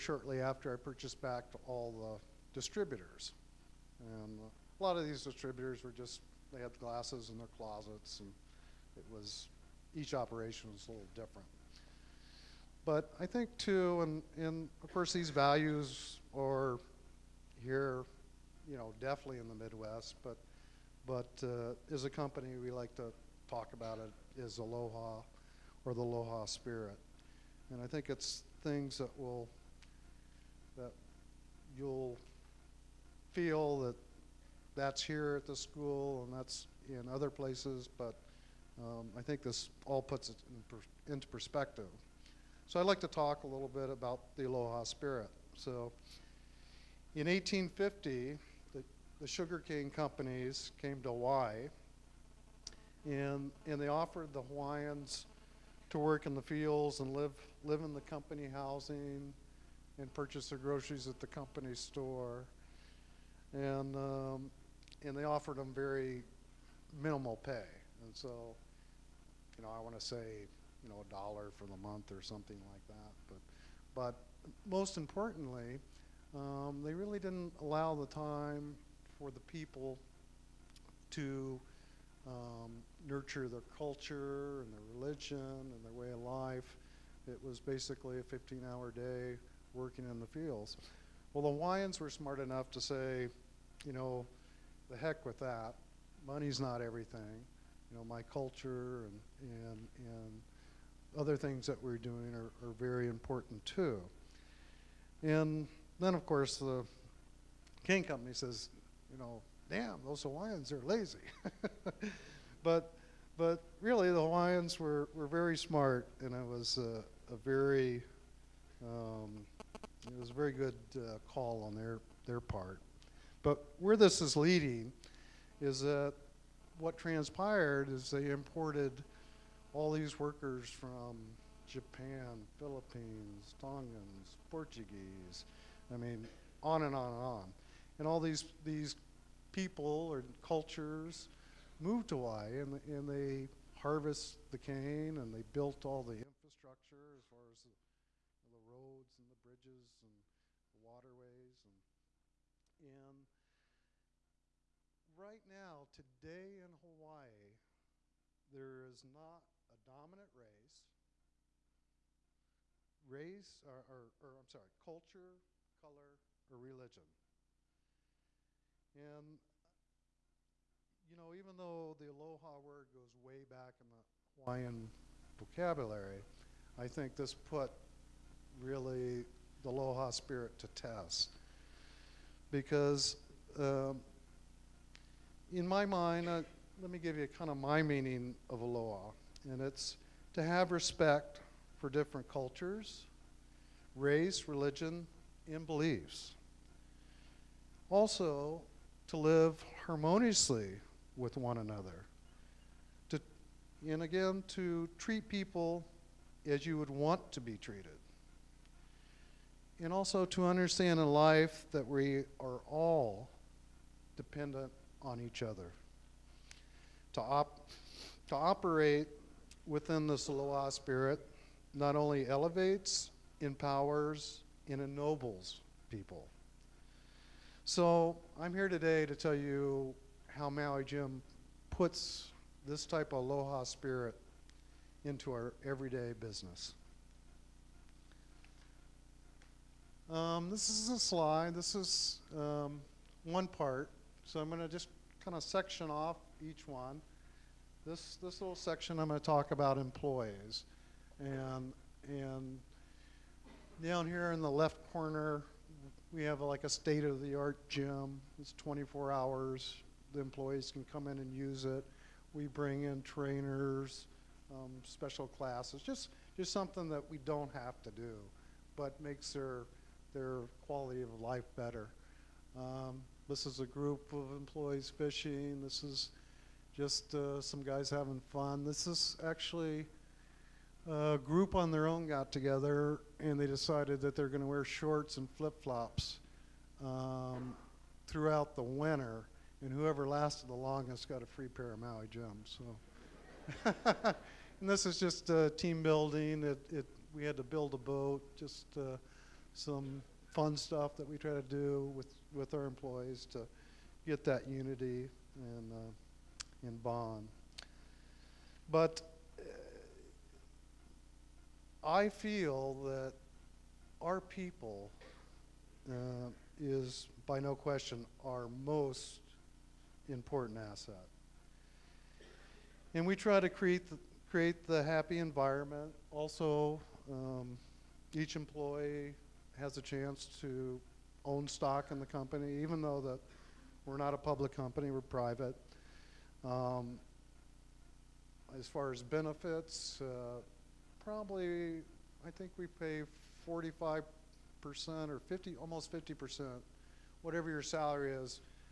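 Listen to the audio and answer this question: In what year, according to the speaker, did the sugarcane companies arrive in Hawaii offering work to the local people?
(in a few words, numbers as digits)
1850.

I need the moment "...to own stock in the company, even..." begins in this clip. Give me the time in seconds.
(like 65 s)
330 s.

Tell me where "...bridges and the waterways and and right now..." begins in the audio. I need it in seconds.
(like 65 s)
149 s.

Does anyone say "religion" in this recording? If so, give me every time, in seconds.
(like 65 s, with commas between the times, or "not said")
85 s, 166 s, 194 s.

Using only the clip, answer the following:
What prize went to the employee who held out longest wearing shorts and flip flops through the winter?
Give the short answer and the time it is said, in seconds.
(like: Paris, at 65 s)
A free pair of Maui Jims, at 291 s.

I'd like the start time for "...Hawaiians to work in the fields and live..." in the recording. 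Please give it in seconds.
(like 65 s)
54 s.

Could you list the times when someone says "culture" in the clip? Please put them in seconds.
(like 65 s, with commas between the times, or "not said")
83 s, 98 s, 140 s, 164 s, 192 s.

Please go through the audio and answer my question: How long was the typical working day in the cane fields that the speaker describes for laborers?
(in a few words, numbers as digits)
15 hours.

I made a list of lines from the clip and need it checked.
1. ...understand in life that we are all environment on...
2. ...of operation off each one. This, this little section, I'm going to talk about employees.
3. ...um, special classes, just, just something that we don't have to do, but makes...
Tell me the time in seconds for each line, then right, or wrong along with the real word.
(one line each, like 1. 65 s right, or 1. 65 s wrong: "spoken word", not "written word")
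1. 210 s wrong: "dependent", not "environment"
2. 245 s wrong: "section", not "operation"
3. 264 s right.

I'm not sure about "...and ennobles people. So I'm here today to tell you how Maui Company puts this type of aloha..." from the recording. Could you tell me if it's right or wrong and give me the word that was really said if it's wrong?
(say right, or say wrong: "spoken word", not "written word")
wrong: "Jim", not "Company".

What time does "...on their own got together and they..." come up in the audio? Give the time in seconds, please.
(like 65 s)
281 s.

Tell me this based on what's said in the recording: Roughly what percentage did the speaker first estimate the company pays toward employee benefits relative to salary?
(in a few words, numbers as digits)
45%.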